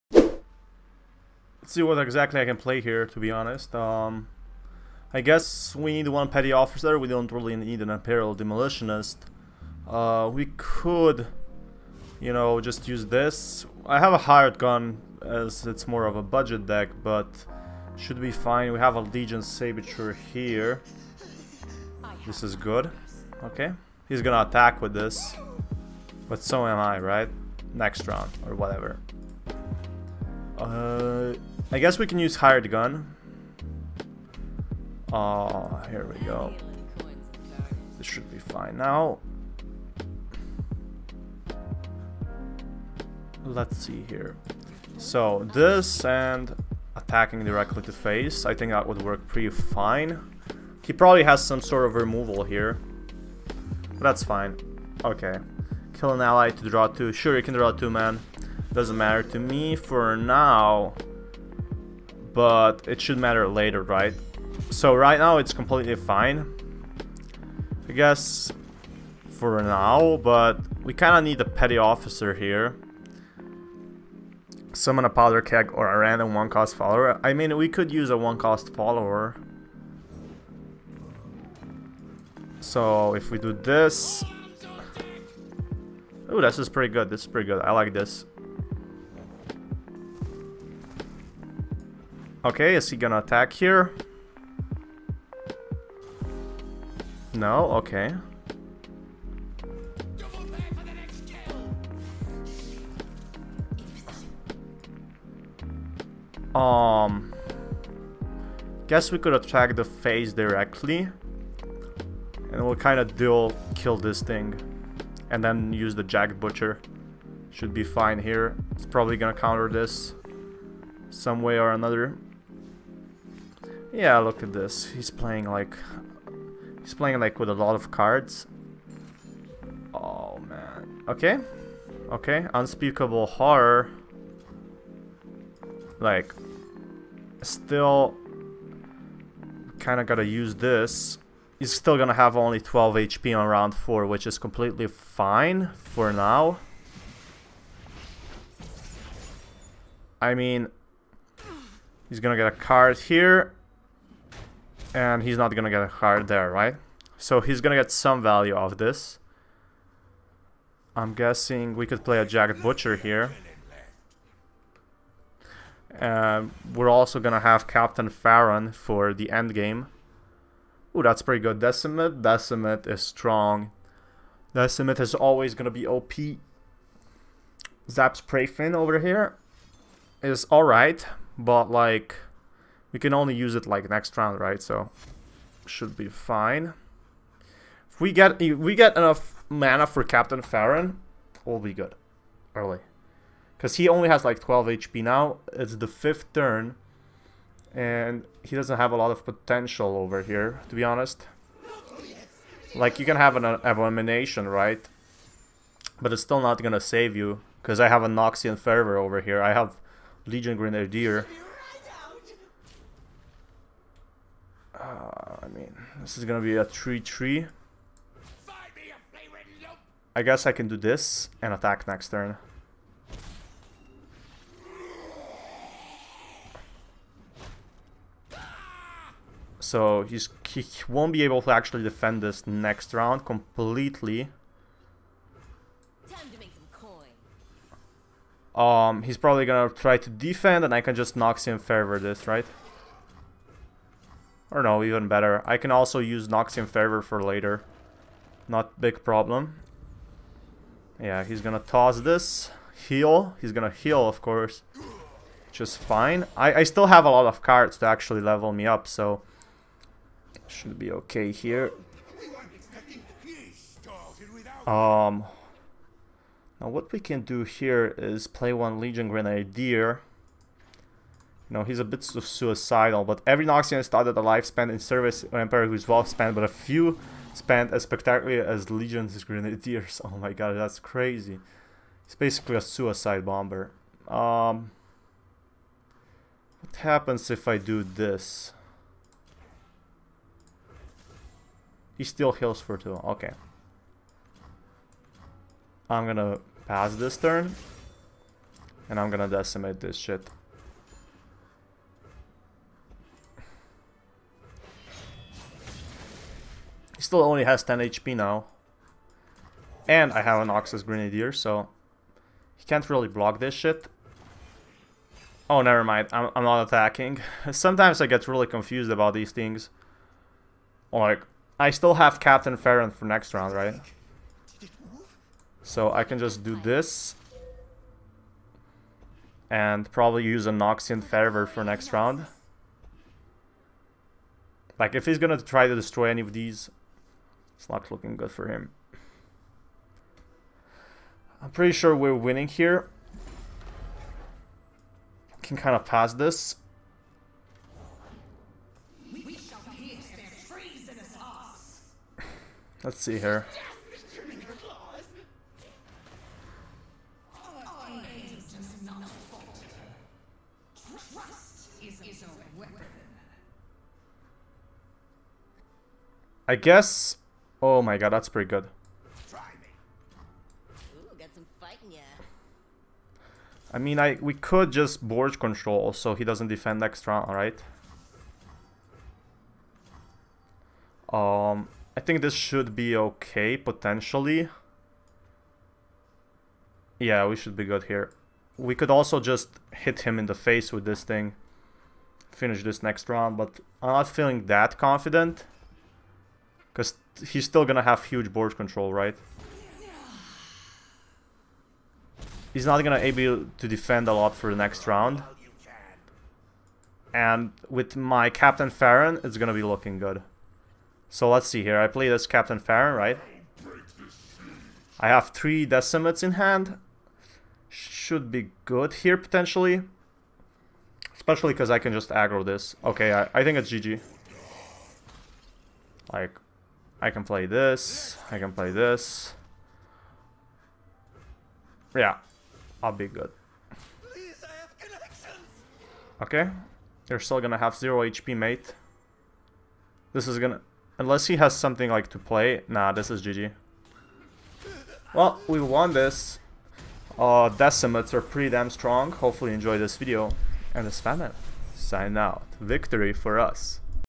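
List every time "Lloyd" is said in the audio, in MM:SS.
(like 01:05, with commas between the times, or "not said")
not said.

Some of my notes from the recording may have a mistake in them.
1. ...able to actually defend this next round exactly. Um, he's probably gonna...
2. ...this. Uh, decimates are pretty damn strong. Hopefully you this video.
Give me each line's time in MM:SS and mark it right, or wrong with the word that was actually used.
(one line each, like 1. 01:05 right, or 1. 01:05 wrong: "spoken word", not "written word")
1. 03:51 wrong: "completely", not "exactly"
2. 07:25 right.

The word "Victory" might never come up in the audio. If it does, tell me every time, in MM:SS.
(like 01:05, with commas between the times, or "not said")
07:32.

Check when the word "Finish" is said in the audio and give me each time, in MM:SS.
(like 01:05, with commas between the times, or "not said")
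06:32.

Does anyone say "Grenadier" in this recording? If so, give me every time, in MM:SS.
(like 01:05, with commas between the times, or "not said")
03:30, 04:29, 04:39, 05:10.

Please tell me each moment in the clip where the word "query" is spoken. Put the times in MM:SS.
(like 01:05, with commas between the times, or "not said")
not said.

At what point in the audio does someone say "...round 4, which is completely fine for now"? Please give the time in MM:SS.
02:23.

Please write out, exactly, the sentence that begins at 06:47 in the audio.
And with my Captain Farron, it's gonna be looking good.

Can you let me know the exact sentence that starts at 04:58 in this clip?
And I'm gonna decimate this shit.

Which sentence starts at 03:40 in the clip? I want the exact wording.
I guess I can do this and attack next turn.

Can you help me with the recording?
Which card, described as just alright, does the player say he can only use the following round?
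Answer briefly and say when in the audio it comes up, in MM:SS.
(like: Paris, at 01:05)
Zap Sprayfin, at 02:57.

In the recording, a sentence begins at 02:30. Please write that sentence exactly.
I mean, he's gonna get a card here and he's not gonna get card there, right?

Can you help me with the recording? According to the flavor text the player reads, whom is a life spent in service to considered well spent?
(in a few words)
an Emperor.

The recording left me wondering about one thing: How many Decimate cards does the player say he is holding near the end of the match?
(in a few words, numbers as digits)
3.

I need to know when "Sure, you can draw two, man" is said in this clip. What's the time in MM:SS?
00:57.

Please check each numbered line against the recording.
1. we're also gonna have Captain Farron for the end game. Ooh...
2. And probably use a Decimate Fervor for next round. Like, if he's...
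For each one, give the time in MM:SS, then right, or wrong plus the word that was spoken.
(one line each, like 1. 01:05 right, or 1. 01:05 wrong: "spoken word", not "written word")
1. 02:45 right
2. 05:29 wrong: "Noxian", not "Decimate".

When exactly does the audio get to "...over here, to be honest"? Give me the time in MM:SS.
03:19.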